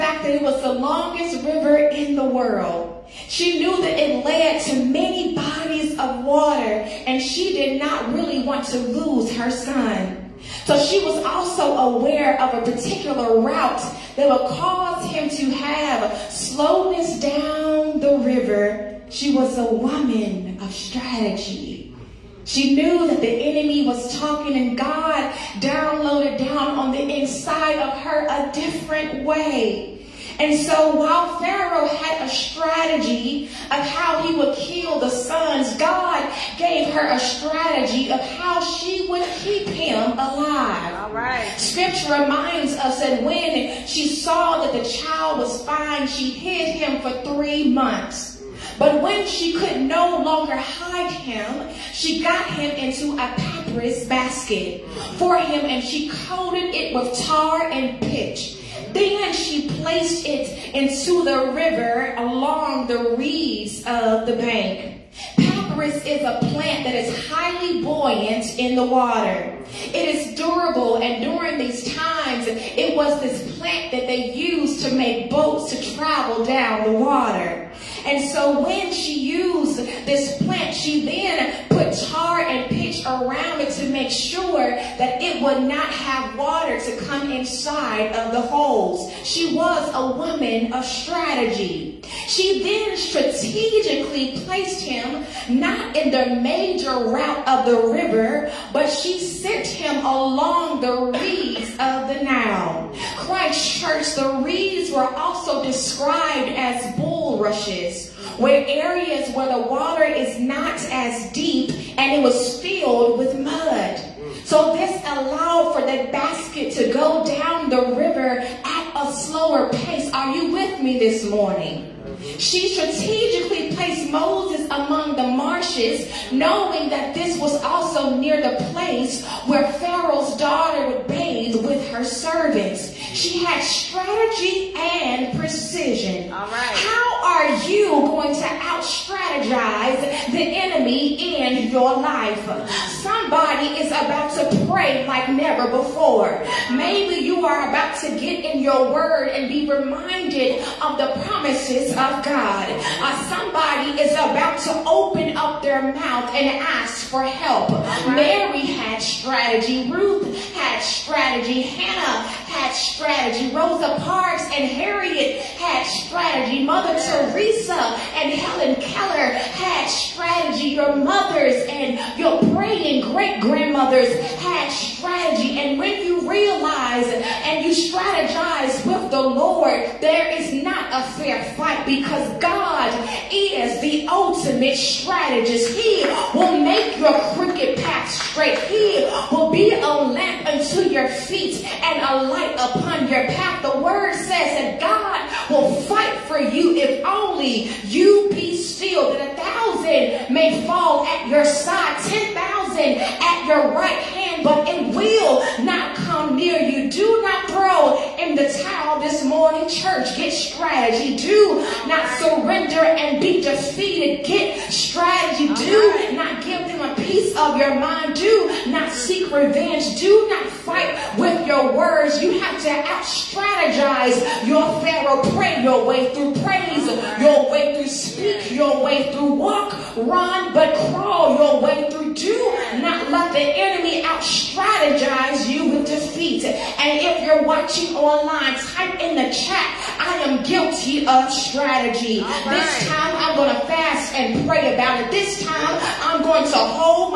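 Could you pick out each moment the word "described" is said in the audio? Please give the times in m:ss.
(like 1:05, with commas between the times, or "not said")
1:45.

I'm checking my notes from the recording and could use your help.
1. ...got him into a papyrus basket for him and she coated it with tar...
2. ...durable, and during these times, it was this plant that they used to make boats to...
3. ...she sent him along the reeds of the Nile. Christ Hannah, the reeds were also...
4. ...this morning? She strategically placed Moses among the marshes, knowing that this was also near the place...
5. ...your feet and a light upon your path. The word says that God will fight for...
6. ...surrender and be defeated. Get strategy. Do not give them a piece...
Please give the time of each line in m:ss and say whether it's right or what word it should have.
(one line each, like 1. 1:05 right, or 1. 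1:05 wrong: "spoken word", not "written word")
1. 0:52 right
2. 1:10 right
3. 1:38 wrong: "Church", not "Hannah"
4. 2:00 right
5. 3:10 right
6. 3:32 right.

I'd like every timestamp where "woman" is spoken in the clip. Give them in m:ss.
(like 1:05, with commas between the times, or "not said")
0:19, 1:30.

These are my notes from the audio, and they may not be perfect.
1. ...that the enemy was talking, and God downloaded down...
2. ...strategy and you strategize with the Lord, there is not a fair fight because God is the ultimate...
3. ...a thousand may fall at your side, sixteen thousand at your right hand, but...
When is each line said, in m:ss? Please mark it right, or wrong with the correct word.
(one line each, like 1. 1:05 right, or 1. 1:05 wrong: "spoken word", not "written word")
1. 0:23 right
2. 2:54 right
3. 3:19 wrong: "ten", not "sixteen".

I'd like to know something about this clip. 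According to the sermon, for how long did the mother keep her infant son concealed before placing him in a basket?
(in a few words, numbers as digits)
3 months.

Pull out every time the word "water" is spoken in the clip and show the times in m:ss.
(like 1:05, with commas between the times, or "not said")
0:06, 1:08, 1:16, 1:26, 1:49.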